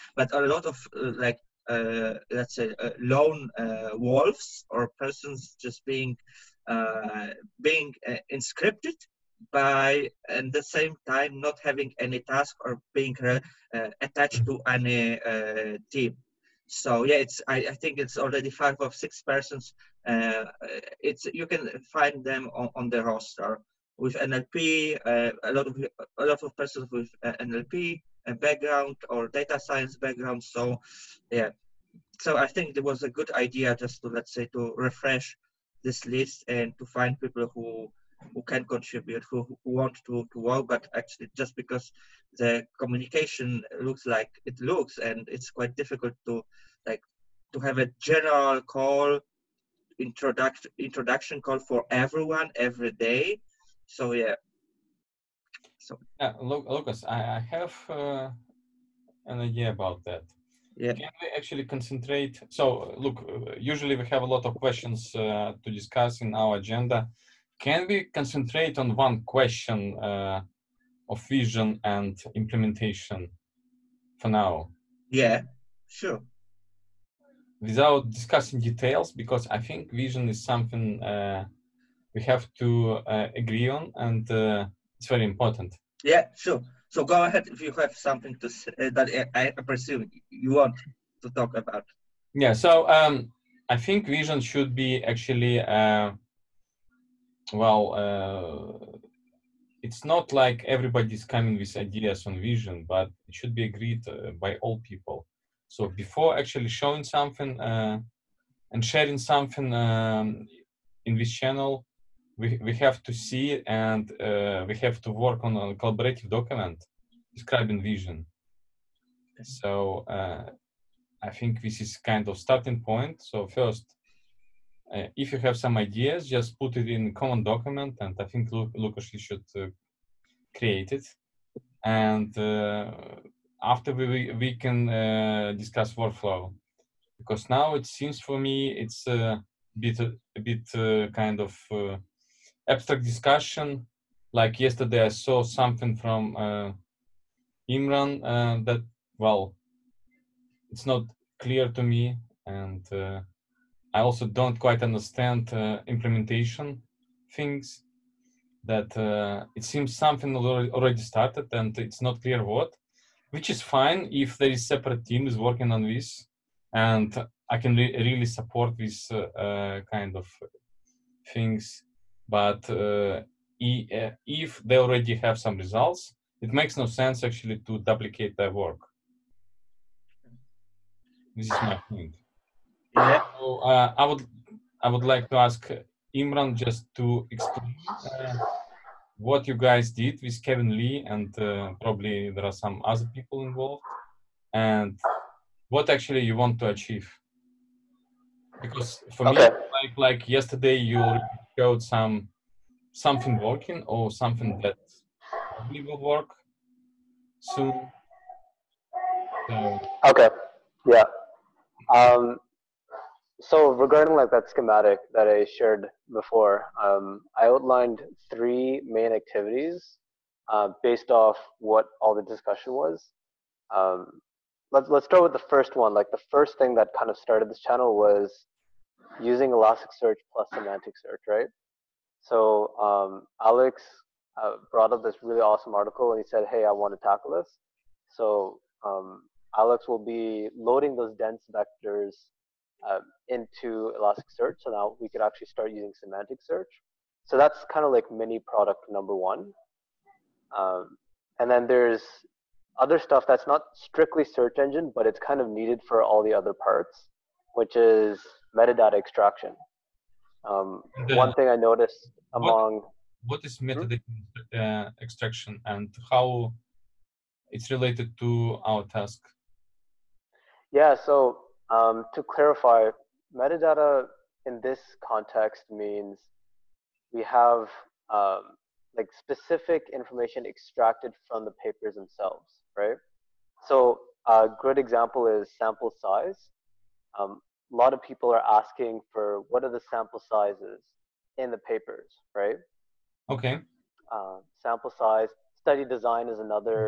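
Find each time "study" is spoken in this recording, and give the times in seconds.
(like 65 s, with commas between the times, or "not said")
295 s.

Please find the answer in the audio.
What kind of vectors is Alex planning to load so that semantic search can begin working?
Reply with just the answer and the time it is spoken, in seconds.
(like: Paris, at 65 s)
dense vectors, at 241 s.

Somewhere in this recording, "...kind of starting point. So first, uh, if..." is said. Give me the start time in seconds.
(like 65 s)
121 s.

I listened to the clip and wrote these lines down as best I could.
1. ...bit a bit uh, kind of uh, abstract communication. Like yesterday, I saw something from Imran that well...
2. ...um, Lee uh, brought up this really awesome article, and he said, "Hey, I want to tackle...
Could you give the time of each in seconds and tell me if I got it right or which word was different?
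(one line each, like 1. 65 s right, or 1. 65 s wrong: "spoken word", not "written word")
1. 139 s wrong: "discussion", not "communication"
2. 232 s wrong: "Alex", not "Lee".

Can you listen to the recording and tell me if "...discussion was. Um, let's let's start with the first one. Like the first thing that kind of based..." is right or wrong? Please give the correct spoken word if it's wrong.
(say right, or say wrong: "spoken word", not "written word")
wrong: "started", not "based".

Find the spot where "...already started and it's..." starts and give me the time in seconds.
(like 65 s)
160 s.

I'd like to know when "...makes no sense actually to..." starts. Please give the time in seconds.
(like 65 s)
176 s.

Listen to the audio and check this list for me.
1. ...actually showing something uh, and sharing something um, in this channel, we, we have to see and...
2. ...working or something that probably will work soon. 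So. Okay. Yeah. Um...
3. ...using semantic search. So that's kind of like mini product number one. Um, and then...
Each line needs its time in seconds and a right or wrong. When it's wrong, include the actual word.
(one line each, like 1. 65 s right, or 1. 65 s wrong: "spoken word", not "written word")
1. 106 s right
2. 203 s right
3. 245 s right.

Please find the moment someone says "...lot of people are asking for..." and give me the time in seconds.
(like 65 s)
287 s.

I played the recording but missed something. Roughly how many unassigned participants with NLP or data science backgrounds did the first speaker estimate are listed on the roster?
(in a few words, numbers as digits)
5 or 6.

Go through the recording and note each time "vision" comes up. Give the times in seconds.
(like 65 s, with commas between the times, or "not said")
71 s, 79 s, 94 s, 102 s, 117 s.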